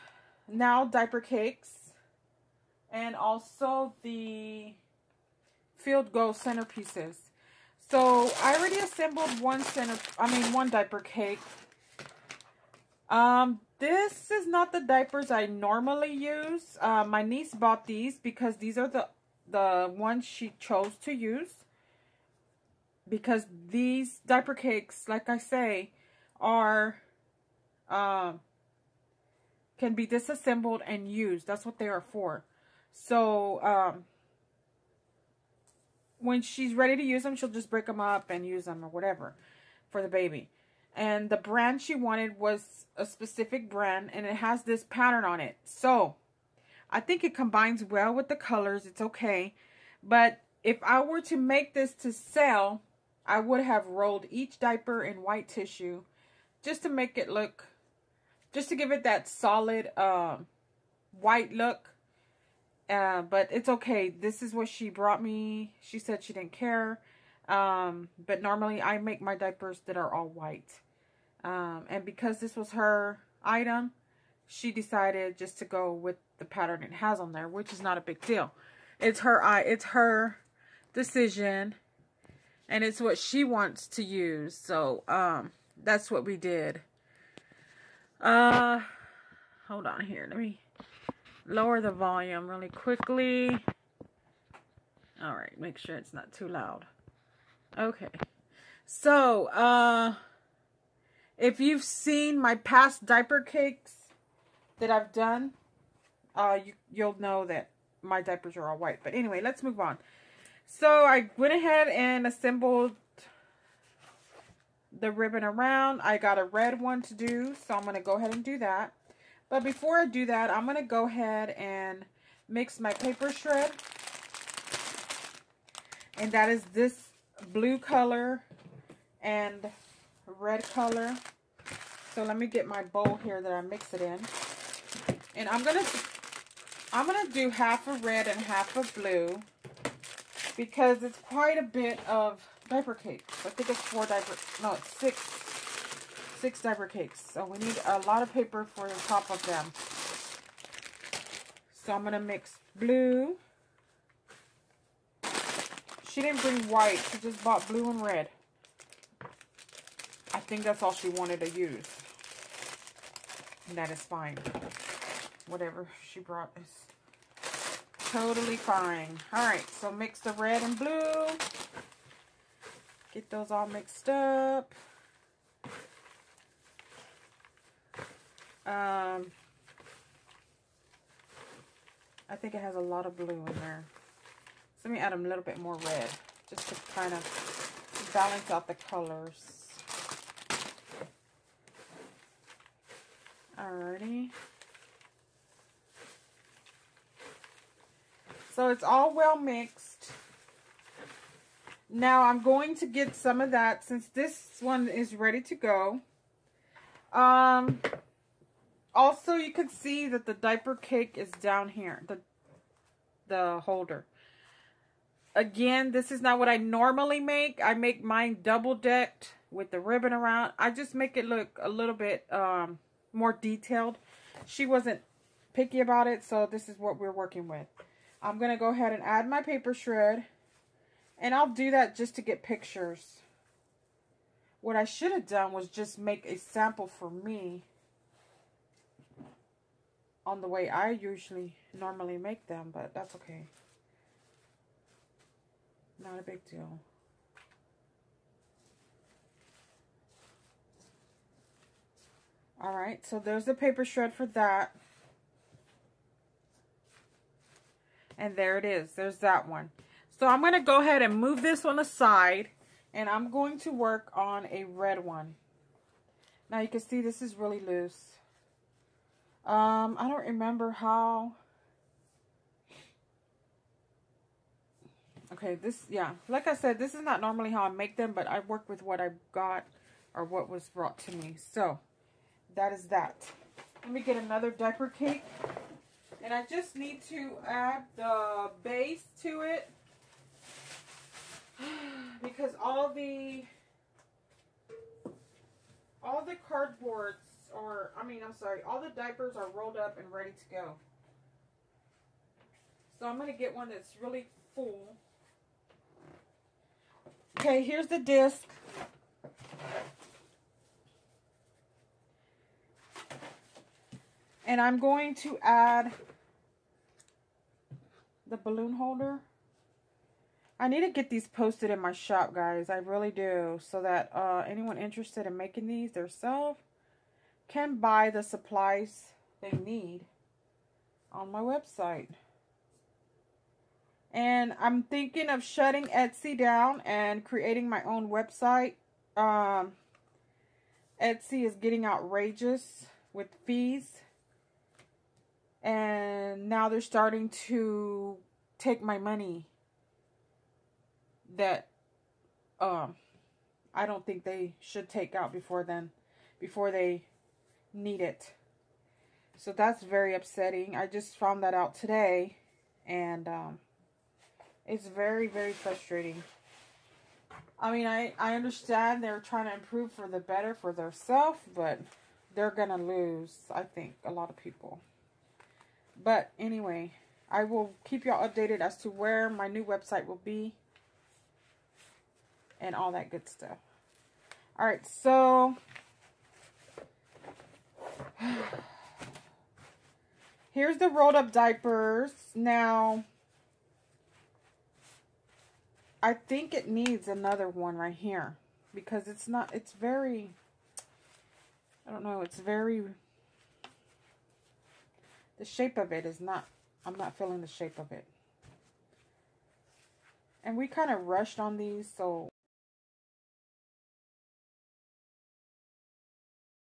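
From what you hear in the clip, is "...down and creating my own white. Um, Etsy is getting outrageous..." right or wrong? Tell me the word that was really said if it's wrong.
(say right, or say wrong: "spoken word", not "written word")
wrong: "website", not "white".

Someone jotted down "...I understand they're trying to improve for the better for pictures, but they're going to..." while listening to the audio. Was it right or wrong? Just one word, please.
wrong.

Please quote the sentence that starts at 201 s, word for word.
Now I'm going to get some of that since this one is ready to go.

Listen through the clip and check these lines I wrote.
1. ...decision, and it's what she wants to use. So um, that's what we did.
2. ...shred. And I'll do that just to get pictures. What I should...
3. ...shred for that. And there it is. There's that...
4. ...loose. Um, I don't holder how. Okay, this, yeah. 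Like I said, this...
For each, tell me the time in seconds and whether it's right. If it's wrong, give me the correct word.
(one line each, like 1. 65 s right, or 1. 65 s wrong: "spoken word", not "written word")
1. 80 s right
2. 229 s right
3. 253 s right
4. 267 s wrong: "remember", not "holder".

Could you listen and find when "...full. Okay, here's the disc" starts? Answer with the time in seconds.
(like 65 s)
304 s.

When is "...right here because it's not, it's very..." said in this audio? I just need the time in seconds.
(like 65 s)
397 s.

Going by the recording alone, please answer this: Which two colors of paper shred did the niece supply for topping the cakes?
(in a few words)
blue and red.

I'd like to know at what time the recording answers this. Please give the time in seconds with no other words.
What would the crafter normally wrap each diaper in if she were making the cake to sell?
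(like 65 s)
55 s.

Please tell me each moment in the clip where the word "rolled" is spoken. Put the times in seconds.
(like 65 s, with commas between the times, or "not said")
53 s, 299 s, 390 s.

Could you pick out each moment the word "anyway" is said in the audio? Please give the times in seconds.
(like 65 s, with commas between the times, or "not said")
109 s, 376 s.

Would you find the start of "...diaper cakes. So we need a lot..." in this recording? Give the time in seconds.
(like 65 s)
146 s.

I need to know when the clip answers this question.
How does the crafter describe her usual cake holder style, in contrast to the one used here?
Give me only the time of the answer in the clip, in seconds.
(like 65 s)
218 s.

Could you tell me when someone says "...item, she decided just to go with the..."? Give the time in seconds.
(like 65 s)
73 s.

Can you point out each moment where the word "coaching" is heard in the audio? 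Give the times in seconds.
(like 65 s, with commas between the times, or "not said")
not said.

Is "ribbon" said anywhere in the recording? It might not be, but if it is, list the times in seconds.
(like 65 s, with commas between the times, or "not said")
115 s, 219 s.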